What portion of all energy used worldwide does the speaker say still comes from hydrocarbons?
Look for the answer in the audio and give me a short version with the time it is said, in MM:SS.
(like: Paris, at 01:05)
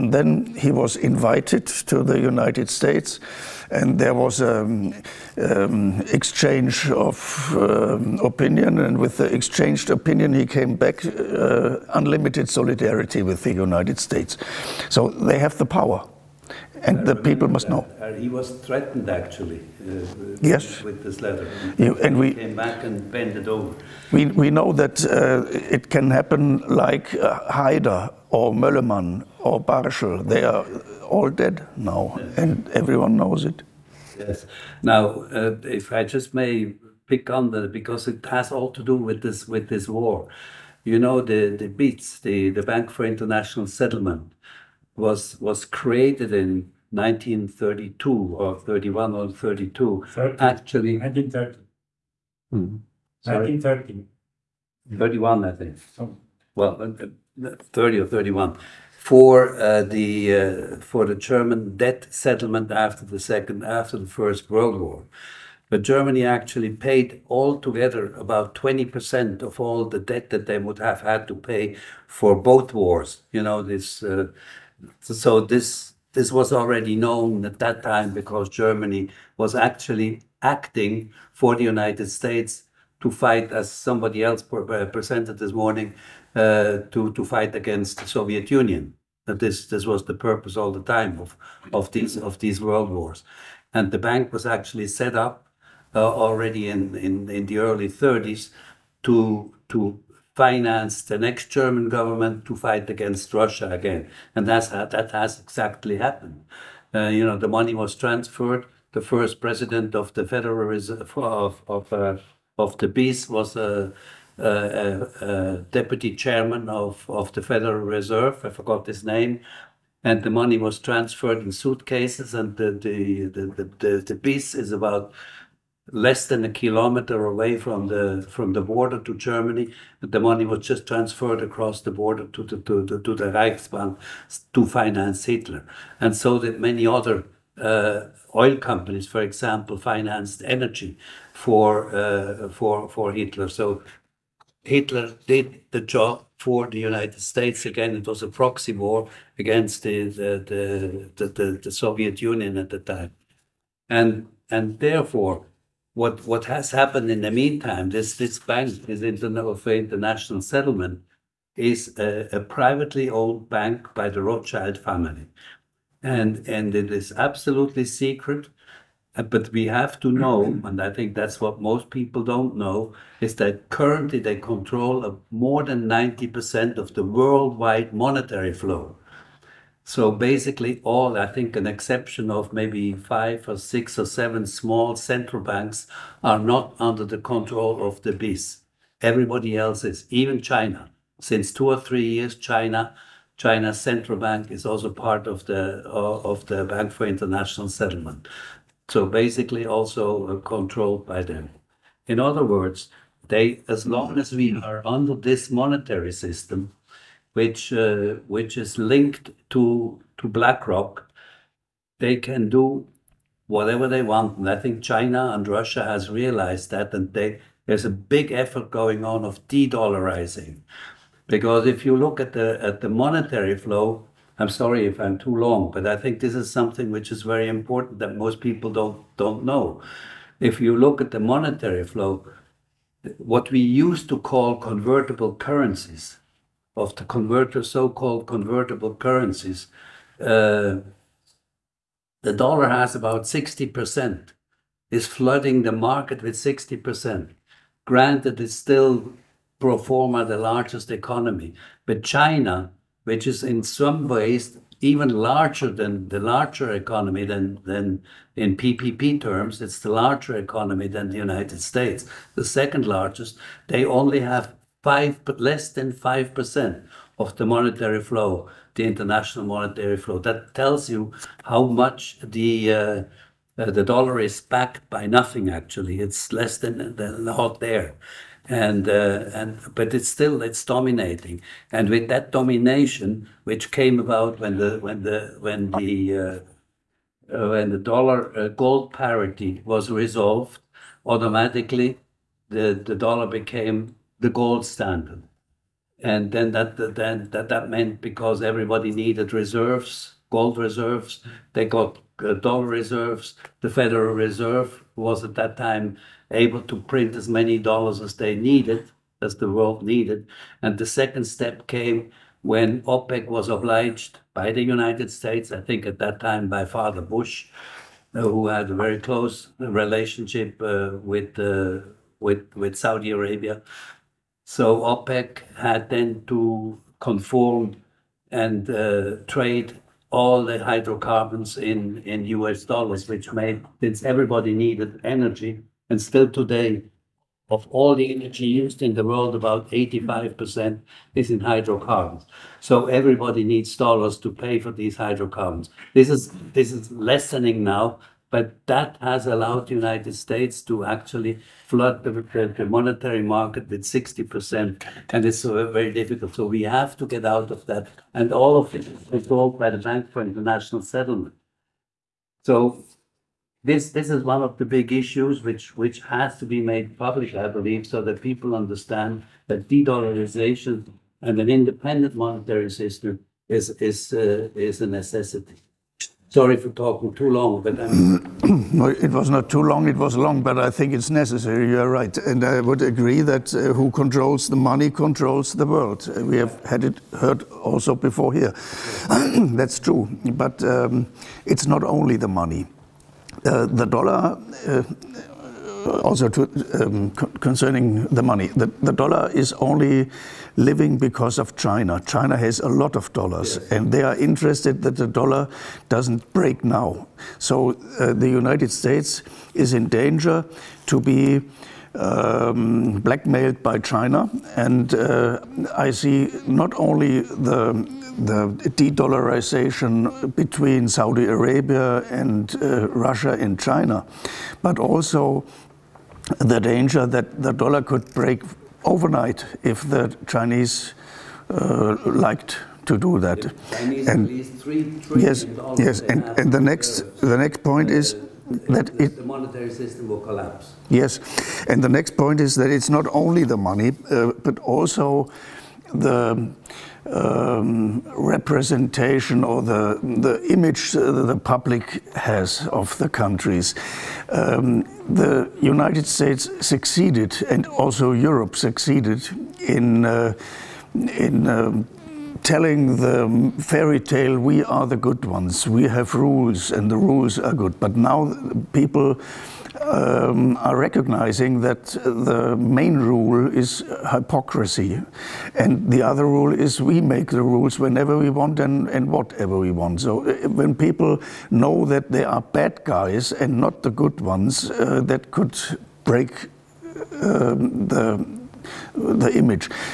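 85%, at 05:39.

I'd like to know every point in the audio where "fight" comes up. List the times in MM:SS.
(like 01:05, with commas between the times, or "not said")
01:23, 01:27, 01:42.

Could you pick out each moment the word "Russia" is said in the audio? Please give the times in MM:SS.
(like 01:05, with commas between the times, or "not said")
01:43, 03:35, 07:02.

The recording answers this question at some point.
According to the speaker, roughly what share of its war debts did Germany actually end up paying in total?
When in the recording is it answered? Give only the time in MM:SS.
01:08.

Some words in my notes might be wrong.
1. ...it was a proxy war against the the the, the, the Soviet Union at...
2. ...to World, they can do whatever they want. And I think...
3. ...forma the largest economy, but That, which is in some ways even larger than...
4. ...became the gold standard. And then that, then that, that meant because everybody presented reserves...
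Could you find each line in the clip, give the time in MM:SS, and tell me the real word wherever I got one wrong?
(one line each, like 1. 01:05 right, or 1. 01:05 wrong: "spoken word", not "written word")
1. 02:27 right
2. 03:30 wrong: "BlackRock", not "World"
3. 04:09 wrong: "China", not "That"
4. 04:53 wrong: "needed", not "presented".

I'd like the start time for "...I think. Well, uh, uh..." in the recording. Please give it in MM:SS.
00:55.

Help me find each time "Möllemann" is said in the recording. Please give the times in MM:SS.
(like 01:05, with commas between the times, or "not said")
00:28.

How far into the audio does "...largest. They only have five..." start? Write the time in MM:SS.
04:22.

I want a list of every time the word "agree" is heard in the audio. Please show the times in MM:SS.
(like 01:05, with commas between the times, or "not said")
06:22.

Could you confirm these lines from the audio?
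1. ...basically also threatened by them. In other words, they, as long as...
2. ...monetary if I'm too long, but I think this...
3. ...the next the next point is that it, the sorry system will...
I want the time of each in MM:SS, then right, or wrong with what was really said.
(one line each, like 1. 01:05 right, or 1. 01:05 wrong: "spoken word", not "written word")
1. 03:19 wrong: "controlled", not "threatened"
2. 03:44 wrong: "sorry", not "monetary"
3. 07:16 wrong: "monetary", not "sorry".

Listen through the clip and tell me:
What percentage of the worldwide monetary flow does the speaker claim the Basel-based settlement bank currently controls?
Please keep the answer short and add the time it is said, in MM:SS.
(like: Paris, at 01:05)
More than 90%, at 02:55.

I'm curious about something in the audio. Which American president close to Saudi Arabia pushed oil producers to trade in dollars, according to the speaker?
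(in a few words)
Father Bush.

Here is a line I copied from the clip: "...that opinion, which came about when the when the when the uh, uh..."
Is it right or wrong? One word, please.
wrong.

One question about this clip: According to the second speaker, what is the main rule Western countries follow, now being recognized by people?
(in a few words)
Hypocrisy.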